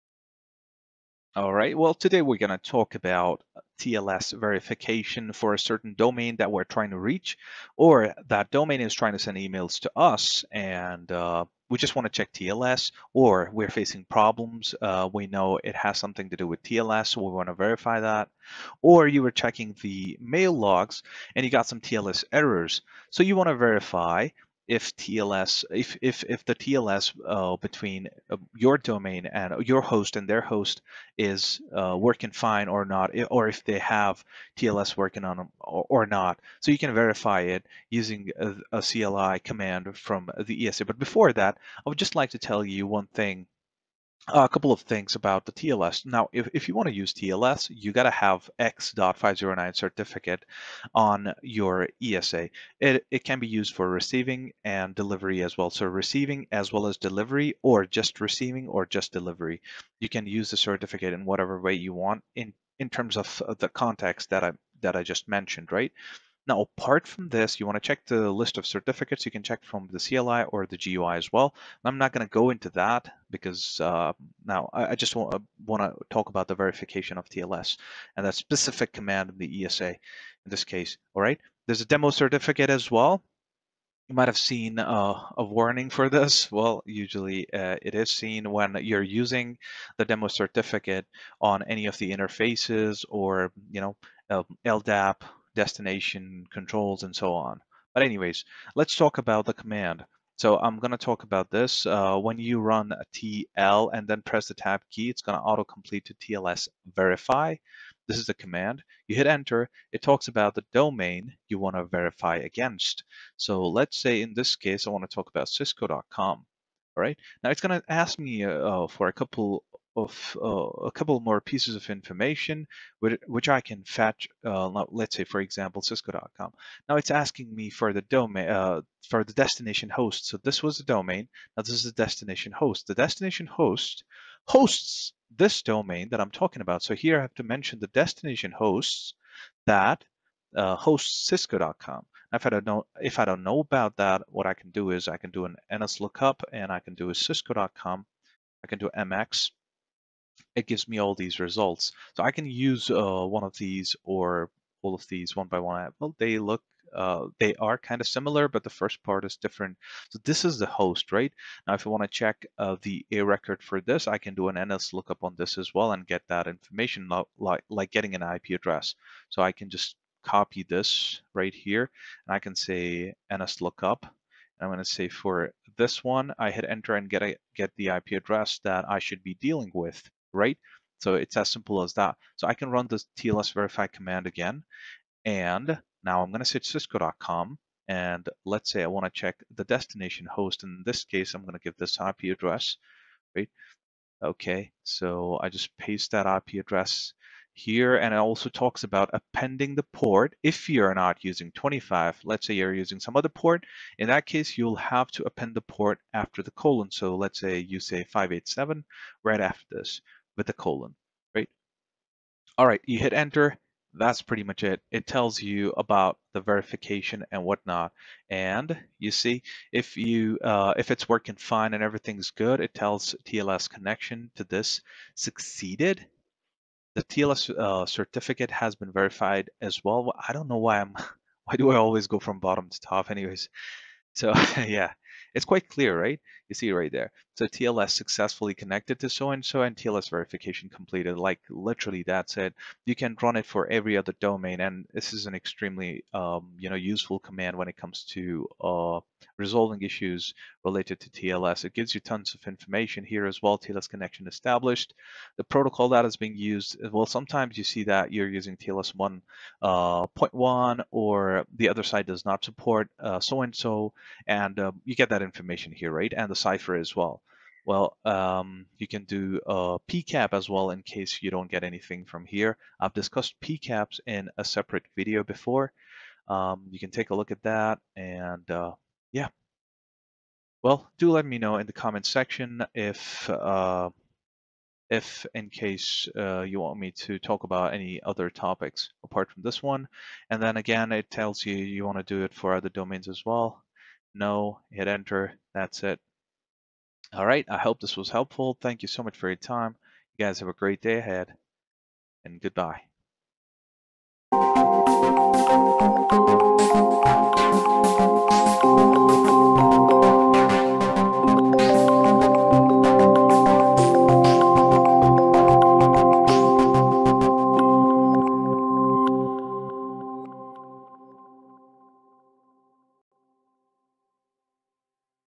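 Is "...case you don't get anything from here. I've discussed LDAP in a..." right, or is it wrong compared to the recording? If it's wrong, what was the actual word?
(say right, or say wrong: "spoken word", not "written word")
wrong: "PCAPs", not "LDAP".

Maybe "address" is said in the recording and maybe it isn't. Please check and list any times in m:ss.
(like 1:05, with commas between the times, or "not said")
2:48, 2:58, 3:12, 3:16.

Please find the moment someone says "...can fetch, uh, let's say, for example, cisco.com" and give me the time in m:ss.
2:03.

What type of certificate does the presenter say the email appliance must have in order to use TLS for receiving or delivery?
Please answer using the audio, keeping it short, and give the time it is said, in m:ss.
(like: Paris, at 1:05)
X.509, at 0:48.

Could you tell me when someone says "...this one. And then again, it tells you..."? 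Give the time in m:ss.
4:49.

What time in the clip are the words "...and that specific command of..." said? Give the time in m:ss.
1:18.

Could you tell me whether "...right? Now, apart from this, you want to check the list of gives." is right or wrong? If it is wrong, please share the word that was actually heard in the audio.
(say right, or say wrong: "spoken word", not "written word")
wrong: "certificates", not "gives".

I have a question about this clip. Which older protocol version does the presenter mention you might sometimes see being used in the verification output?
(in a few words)
TLS 1.1.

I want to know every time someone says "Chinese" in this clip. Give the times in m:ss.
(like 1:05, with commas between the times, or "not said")
not said.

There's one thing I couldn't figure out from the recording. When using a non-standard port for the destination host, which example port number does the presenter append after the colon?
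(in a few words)
587.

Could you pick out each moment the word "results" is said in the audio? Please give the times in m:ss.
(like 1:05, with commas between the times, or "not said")
2:31.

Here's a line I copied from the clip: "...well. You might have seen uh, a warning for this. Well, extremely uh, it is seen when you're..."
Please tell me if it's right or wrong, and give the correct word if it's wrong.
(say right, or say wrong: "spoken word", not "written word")
wrong: "usually", not "extremely".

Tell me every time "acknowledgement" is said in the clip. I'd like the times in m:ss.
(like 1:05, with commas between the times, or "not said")
not said.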